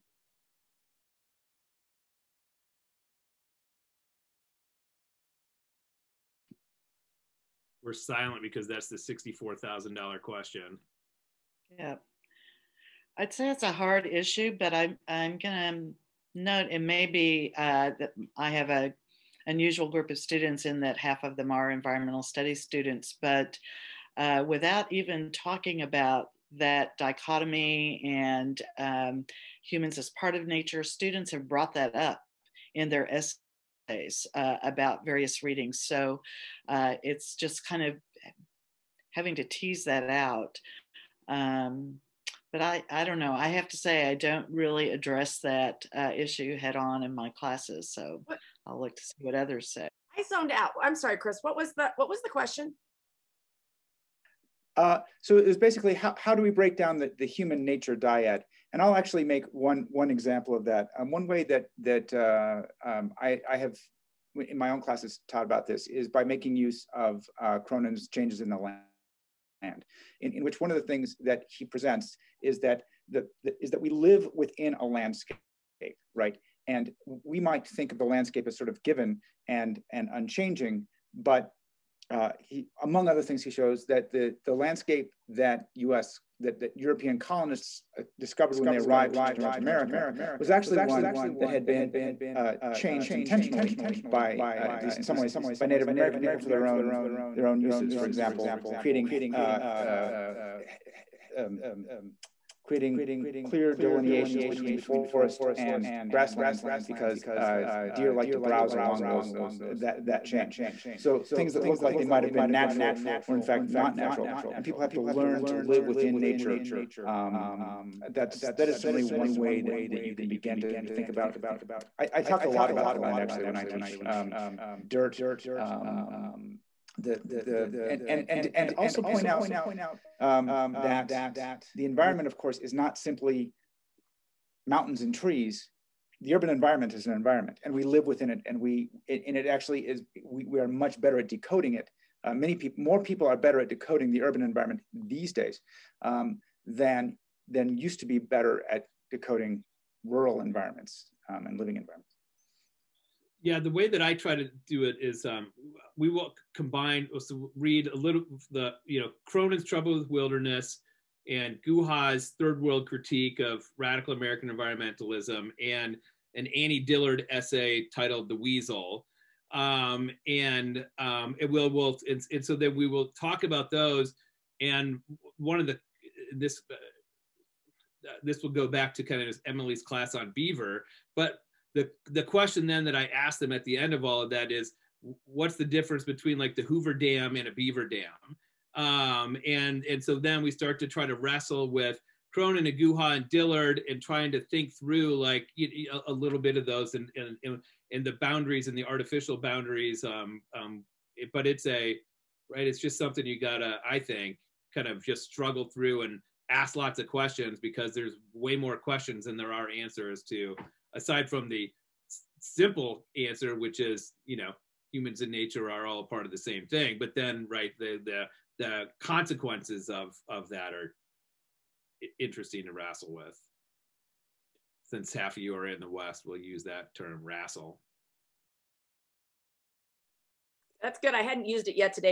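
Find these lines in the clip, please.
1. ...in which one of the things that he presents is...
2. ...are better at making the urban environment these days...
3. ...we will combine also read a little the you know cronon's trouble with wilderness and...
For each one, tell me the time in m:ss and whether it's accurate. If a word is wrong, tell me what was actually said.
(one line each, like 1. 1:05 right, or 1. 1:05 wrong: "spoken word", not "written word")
1. 1:10 right
2. 2:23 wrong: "decoding", not "making"
3. 2:35 right.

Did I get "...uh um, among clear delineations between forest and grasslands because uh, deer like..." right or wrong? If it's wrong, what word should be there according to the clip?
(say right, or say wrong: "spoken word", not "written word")
wrong: "creating", not "among".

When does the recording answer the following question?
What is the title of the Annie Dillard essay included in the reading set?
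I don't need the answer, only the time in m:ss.
2:48.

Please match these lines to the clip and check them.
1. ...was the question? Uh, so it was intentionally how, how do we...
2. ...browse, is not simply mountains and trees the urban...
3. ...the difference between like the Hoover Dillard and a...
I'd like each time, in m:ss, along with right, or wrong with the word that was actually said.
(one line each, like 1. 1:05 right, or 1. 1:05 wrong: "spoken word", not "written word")
1. 0:52 wrong: "basically", not "intentionally"
2. 2:12 wrong: "course", not "browse"
3. 3:05 wrong: "Dam", not "Dillard".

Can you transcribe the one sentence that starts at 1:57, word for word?
Um, that's that is certainly one way that that you can begin to think about.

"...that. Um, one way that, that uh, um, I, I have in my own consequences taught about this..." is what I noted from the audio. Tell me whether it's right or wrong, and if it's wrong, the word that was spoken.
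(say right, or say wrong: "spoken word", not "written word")
wrong: "classes", not "consequences".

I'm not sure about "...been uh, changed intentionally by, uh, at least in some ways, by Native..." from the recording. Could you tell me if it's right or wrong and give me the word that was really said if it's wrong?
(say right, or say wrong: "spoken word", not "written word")
right.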